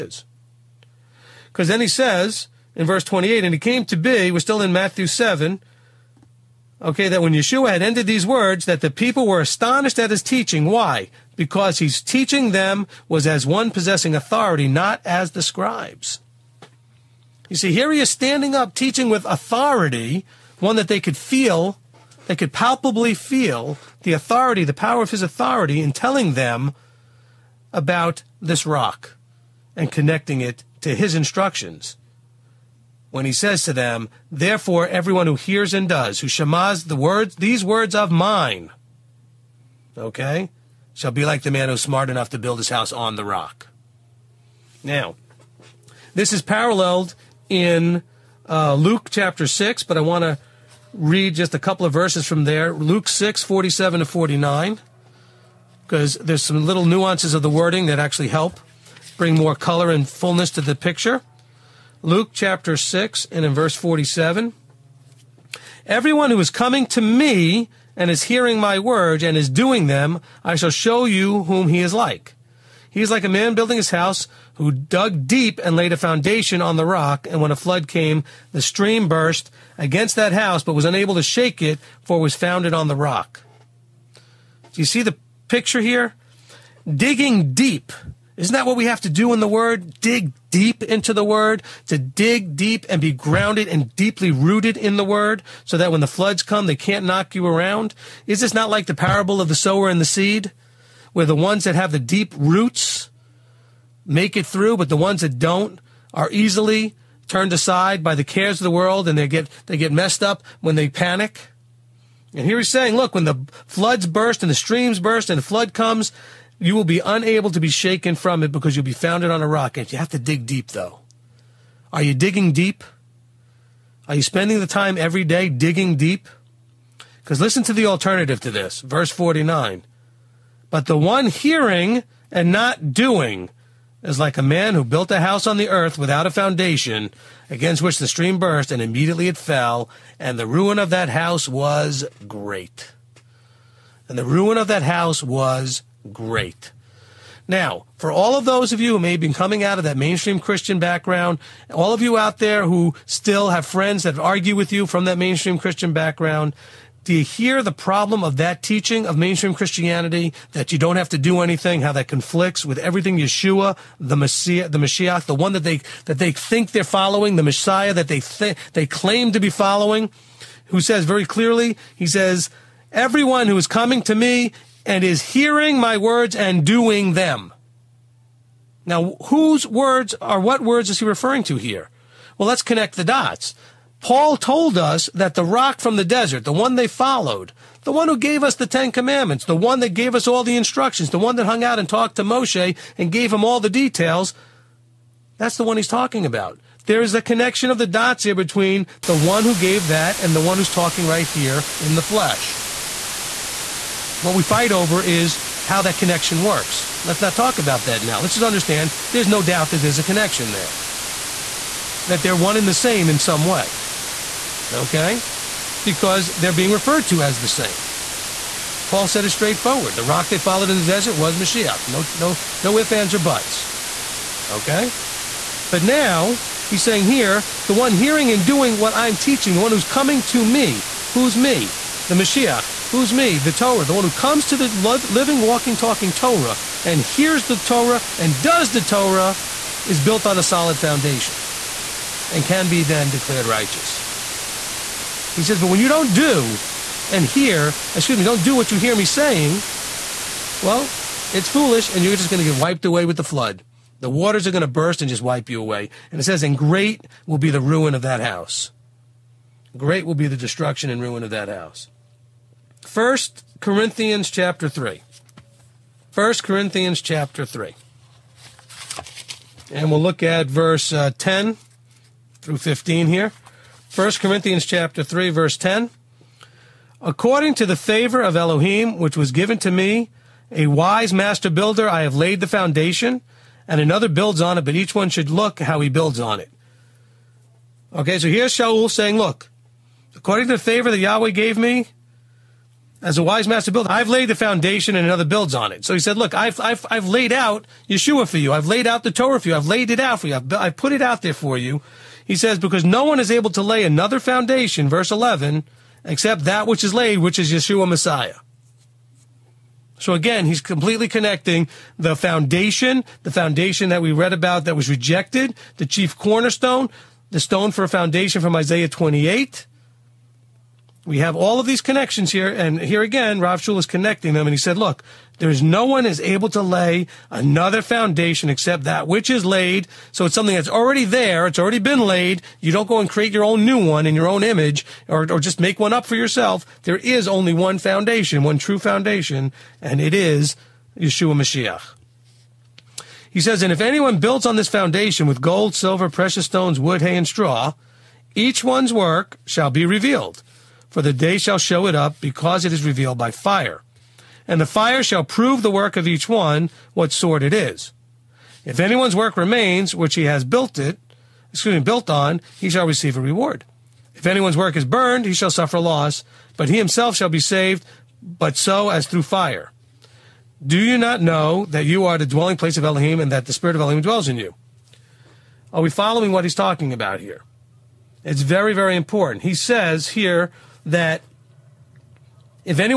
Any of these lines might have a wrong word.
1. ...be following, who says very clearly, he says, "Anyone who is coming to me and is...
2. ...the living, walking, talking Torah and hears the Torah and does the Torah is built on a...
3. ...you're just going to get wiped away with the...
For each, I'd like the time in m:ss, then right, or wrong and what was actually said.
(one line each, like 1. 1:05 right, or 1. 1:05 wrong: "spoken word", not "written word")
1. 2:49 wrong: "Everyone", not "Anyone"
2. 3:54 right
3. 4:12 right.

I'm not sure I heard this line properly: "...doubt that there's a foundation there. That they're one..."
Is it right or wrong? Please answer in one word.
wrong.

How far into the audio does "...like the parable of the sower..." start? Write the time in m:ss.
1:38.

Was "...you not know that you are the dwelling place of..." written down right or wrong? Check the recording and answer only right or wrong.
right.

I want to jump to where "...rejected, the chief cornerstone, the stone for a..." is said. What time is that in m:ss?
5:14.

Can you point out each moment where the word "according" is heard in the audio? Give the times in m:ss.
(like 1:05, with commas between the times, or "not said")
4:37, 4:50.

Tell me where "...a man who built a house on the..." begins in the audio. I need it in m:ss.
2:14.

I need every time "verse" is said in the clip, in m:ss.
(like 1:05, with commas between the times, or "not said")
0:02, 0:51, 1:03, 2:08, 4:30, 4:35, 5:04.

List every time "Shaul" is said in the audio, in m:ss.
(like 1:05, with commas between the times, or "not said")
4:48, 5:23.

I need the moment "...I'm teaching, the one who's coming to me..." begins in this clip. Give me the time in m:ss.
3:48.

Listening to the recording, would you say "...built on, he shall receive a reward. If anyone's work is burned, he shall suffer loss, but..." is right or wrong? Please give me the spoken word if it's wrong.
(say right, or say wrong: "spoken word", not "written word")
right.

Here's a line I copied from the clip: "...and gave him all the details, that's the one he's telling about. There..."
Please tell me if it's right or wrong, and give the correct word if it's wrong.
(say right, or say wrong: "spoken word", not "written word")
wrong: "talking", not "telling".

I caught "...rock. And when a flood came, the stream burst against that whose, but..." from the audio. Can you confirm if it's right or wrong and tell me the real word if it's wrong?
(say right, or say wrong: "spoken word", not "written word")
wrong: "house", not "whose".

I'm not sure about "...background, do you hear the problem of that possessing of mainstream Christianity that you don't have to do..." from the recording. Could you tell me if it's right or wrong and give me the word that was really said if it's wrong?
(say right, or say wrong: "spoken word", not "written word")
wrong: "teaching", not "possessing".